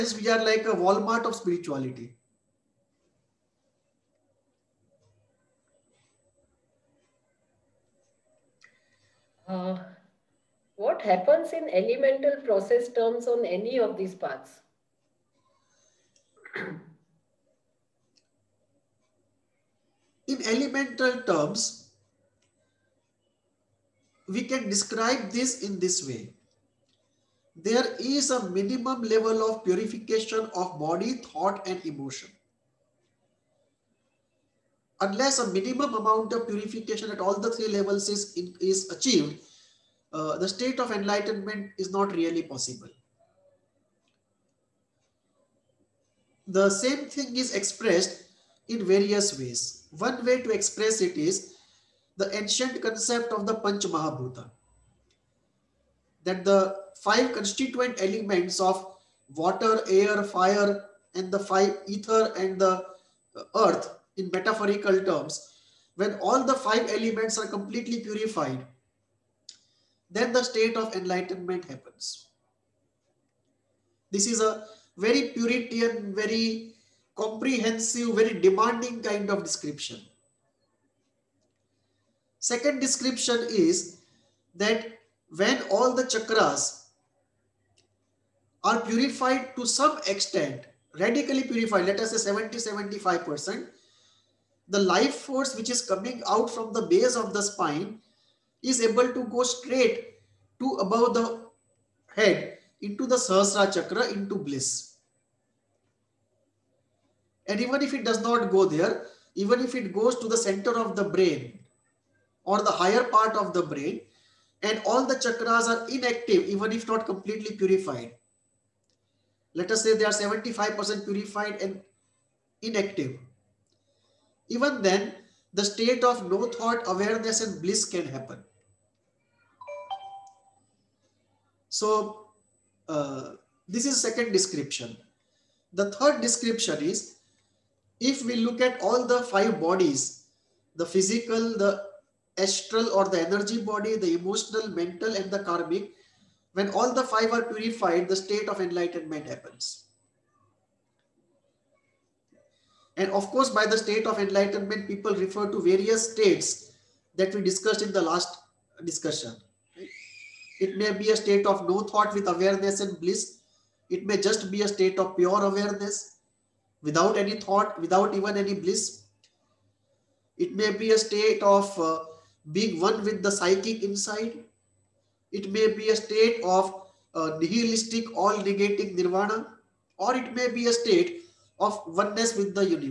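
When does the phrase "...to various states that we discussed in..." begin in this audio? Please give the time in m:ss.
2:35.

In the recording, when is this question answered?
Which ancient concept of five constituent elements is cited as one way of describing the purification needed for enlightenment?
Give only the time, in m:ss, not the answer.
0:53.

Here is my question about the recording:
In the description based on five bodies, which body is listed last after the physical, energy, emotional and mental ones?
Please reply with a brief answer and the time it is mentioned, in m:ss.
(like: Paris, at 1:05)
Karmic, at 2:25.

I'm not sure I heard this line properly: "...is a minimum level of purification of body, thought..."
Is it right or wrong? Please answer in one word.
right.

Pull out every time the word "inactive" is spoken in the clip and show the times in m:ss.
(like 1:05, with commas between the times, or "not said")
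1:55, 2:02.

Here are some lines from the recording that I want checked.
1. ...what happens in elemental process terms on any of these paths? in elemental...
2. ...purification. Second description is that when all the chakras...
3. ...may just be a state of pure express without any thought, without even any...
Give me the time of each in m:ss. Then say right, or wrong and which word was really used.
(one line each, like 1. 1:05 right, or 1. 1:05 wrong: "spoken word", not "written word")
1. 0:10 right
2. 1:19 wrong: "description", not "purification"
3. 2:44 wrong: "awareness", not "express".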